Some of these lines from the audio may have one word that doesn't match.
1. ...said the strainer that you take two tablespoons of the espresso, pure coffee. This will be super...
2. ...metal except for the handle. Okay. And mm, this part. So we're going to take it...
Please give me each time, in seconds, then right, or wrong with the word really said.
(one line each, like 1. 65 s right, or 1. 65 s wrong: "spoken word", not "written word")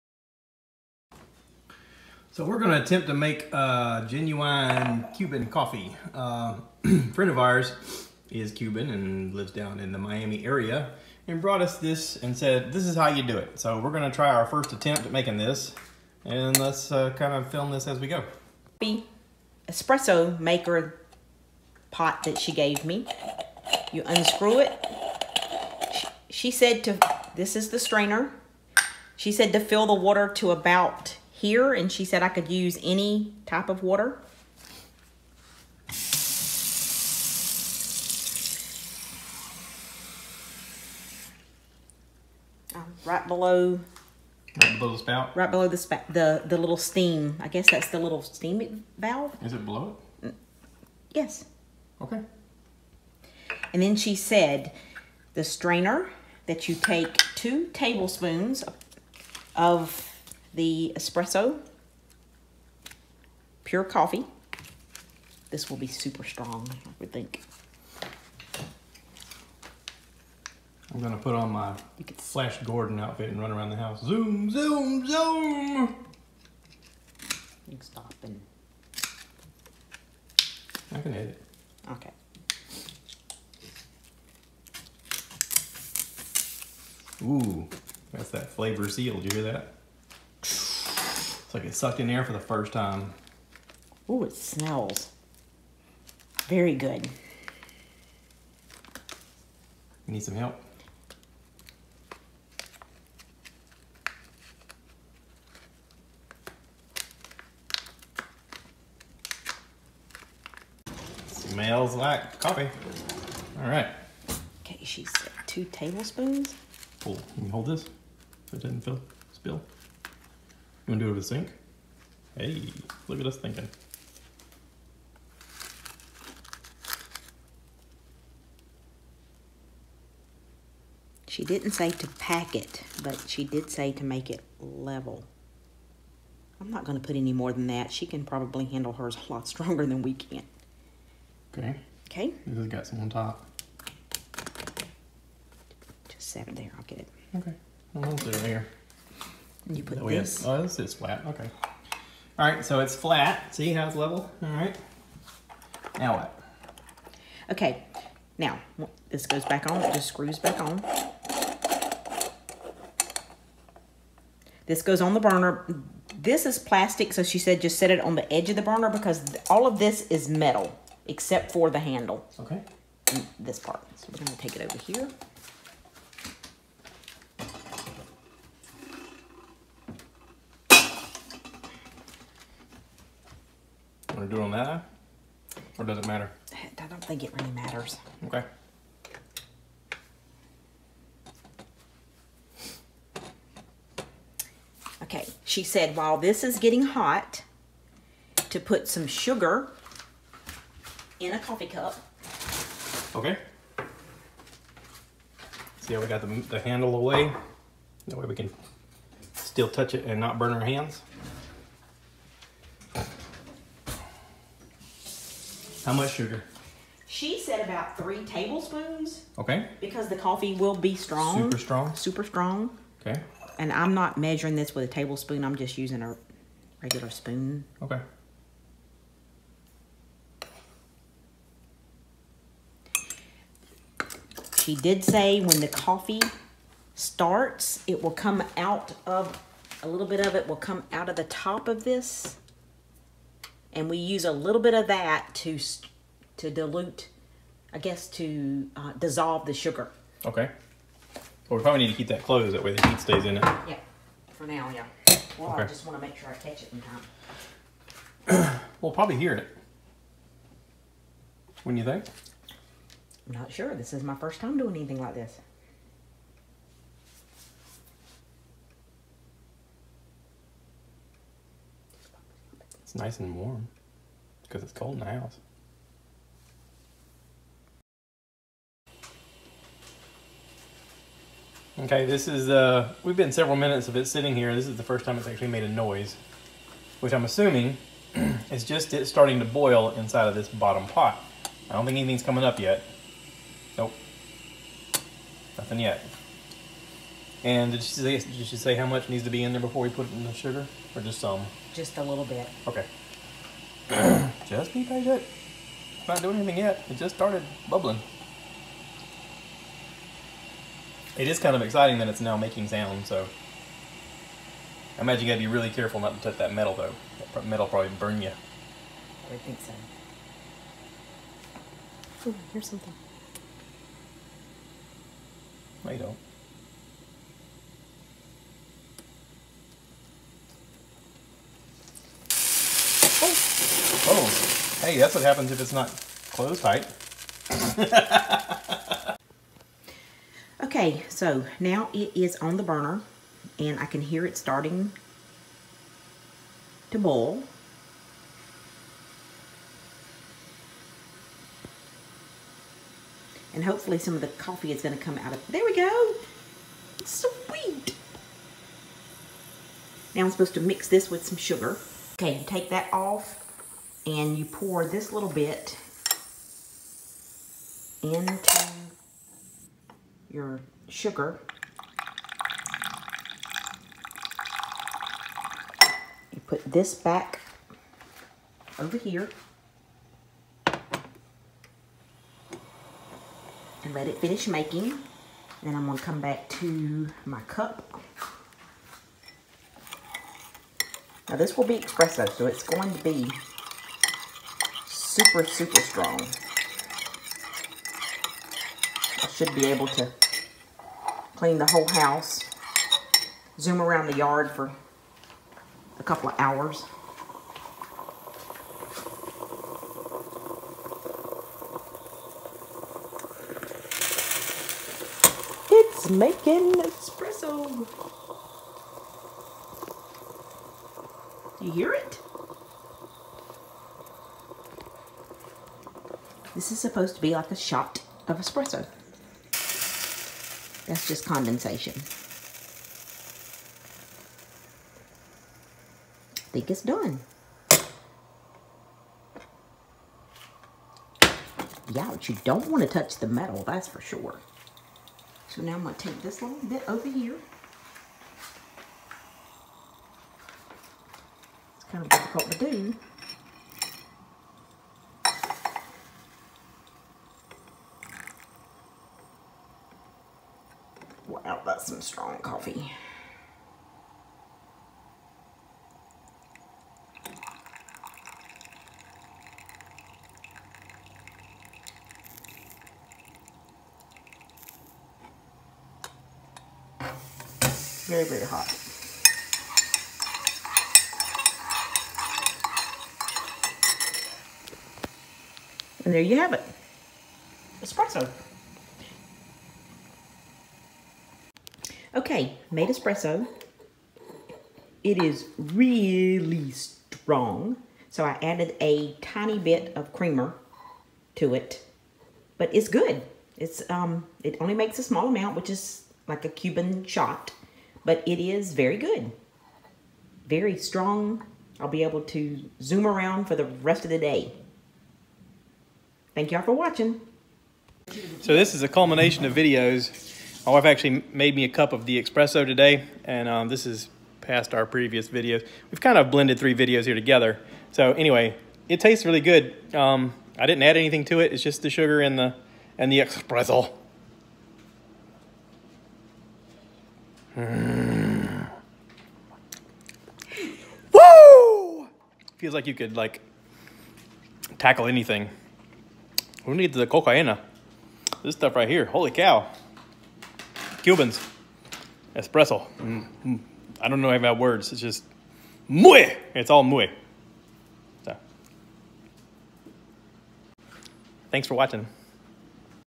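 1. 54 s right
2. 170 s right.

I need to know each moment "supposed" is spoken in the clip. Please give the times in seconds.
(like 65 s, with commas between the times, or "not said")
360 s, 426 s.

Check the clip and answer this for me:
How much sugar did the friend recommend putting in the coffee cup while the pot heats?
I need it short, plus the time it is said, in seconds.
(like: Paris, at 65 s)
3 tablespoons, at 217 s.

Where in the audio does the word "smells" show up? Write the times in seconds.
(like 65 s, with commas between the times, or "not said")
94 s, 111 s.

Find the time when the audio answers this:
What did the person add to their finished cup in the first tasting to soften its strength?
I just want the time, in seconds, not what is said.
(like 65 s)
500 s.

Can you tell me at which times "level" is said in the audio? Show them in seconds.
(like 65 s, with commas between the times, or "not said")
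134 s, 153 s.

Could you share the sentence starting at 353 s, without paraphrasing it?
And hopefully some of the coffee is going to come out of There we go.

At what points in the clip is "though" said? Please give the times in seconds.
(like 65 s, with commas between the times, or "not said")
316 s.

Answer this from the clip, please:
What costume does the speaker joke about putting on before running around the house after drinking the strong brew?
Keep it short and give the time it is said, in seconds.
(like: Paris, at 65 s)
Flash Gordon outfit, at 72 s.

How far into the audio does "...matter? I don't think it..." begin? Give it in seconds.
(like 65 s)
186 s.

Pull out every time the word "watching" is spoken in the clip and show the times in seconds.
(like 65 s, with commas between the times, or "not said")
516 s, 561 s.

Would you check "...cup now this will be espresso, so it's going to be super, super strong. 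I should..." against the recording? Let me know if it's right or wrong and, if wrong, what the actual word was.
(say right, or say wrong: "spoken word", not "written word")
right.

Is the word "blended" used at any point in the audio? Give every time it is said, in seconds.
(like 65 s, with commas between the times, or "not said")
526 s.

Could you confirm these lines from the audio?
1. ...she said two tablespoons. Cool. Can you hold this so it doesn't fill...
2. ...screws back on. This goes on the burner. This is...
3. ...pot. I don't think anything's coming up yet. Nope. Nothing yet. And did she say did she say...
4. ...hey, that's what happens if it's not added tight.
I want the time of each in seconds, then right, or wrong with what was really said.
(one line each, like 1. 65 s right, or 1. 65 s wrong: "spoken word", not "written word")
1. 114 s right
2. 160 s right
3. 290 s right
4. 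334 s wrong: "closed", not "added".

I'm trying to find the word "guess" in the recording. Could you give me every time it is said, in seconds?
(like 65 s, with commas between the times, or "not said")
47 s, 247 s.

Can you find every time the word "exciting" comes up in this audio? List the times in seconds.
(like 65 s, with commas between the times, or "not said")
311 s.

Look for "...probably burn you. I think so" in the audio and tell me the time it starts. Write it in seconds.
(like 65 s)
317 s.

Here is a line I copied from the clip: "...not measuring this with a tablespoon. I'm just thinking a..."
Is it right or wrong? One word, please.
wrong.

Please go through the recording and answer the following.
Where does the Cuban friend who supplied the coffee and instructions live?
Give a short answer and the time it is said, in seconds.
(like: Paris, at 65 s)
Miami area, at 9 s.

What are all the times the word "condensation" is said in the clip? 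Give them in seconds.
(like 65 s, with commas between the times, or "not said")
431 s.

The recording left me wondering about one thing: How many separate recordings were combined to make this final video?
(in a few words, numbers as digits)
3.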